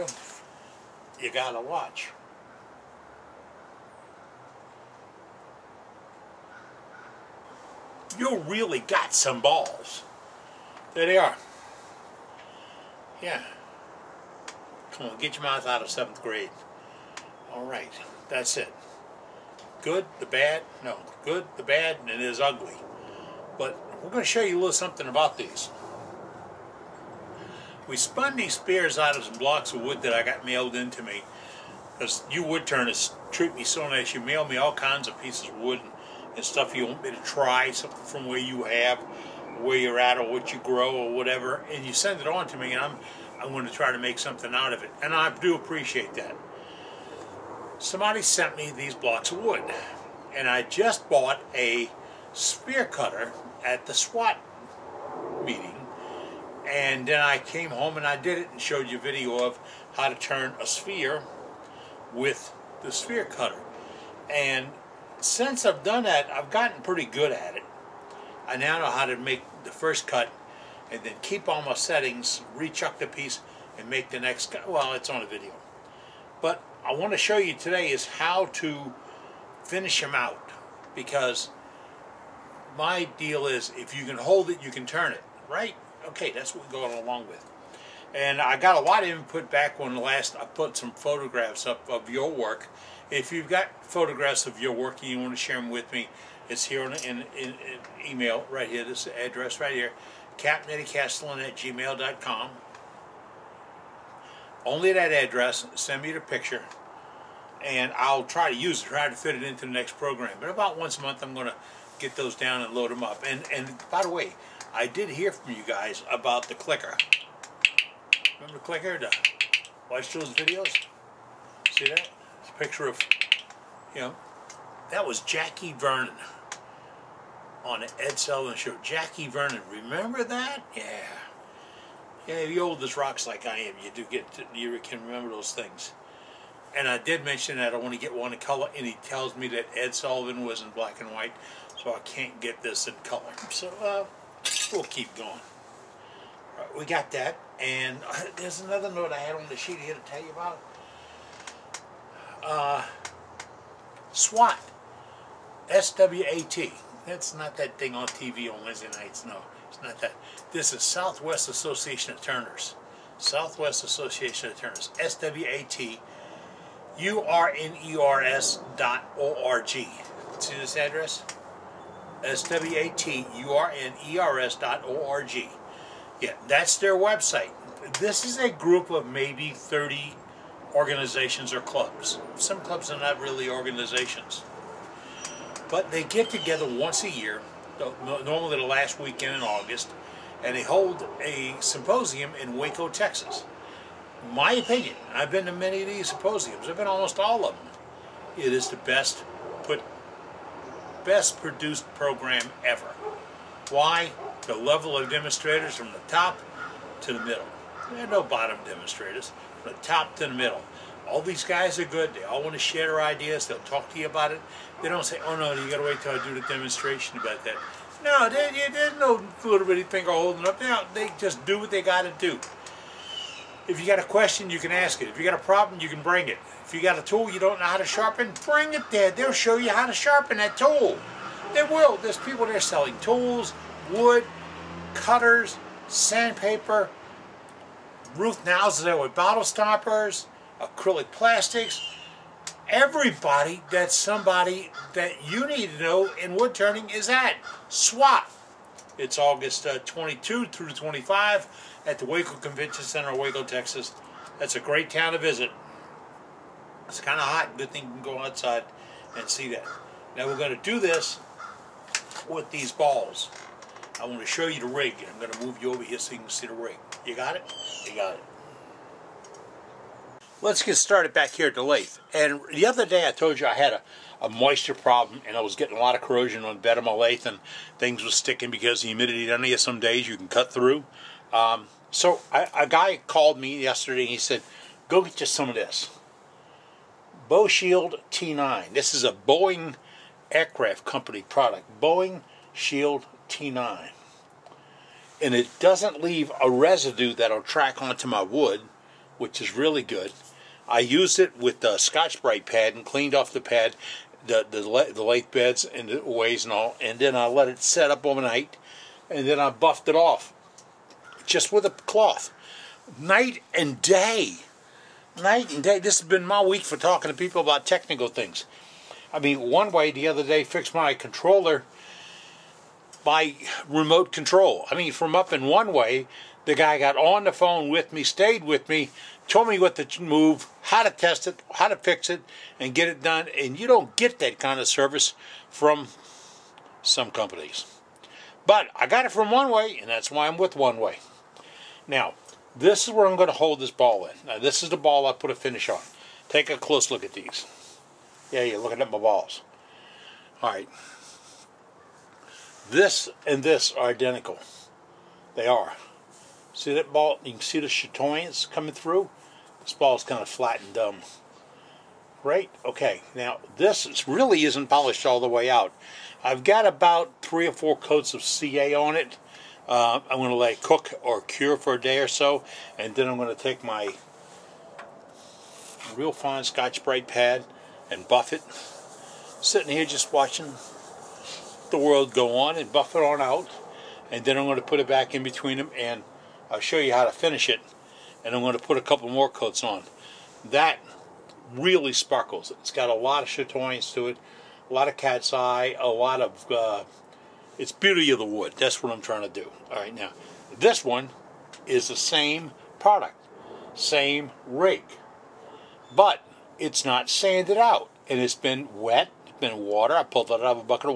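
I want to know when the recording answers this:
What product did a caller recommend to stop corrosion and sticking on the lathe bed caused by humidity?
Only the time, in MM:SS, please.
04:47.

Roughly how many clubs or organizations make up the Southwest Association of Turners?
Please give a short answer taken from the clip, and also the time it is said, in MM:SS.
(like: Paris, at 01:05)
30, at 02:59.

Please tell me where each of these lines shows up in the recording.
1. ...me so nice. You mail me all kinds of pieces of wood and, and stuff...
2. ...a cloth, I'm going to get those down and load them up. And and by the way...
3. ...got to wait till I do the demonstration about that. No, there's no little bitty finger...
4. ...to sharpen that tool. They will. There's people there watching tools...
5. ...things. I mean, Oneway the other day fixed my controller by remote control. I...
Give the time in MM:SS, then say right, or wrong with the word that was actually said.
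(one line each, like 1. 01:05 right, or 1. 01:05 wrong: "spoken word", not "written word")
1. 00:33 right
2. 01:50 wrong: "month", not "cloth"
3. 03:35 right
4. 03:49 wrong: "selling", not "watching"
5. 05:18 right.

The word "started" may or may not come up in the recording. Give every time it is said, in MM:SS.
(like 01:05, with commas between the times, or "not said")
04:30.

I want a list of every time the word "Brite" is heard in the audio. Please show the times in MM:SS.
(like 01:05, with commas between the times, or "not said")
05:02, 06:16.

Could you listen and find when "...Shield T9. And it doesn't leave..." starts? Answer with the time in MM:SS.
04:52.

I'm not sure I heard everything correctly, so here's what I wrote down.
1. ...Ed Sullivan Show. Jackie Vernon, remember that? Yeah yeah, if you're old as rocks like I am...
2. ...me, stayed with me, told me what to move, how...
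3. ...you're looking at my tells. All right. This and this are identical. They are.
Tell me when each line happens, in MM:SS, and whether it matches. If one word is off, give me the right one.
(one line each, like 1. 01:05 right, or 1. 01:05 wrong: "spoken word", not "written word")
1. 02:07 right
2. 05:27 right
3. 05:48 wrong: "balls", not "tells".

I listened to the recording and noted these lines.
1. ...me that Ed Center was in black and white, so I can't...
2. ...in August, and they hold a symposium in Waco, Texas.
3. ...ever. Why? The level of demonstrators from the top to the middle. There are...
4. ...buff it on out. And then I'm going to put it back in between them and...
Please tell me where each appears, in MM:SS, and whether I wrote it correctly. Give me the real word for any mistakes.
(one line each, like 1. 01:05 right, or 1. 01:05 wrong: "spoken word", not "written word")
1. 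02:19 wrong: "Sullivan", not "Center"
2. 03:09 right
3. 03:22 right
4. 06:22 right.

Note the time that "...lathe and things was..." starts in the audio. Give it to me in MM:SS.
04:36.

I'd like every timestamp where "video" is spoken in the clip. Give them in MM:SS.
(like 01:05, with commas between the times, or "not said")
00:58, 01:15, 02:00.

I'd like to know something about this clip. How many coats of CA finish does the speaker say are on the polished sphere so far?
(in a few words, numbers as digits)
3 or 4.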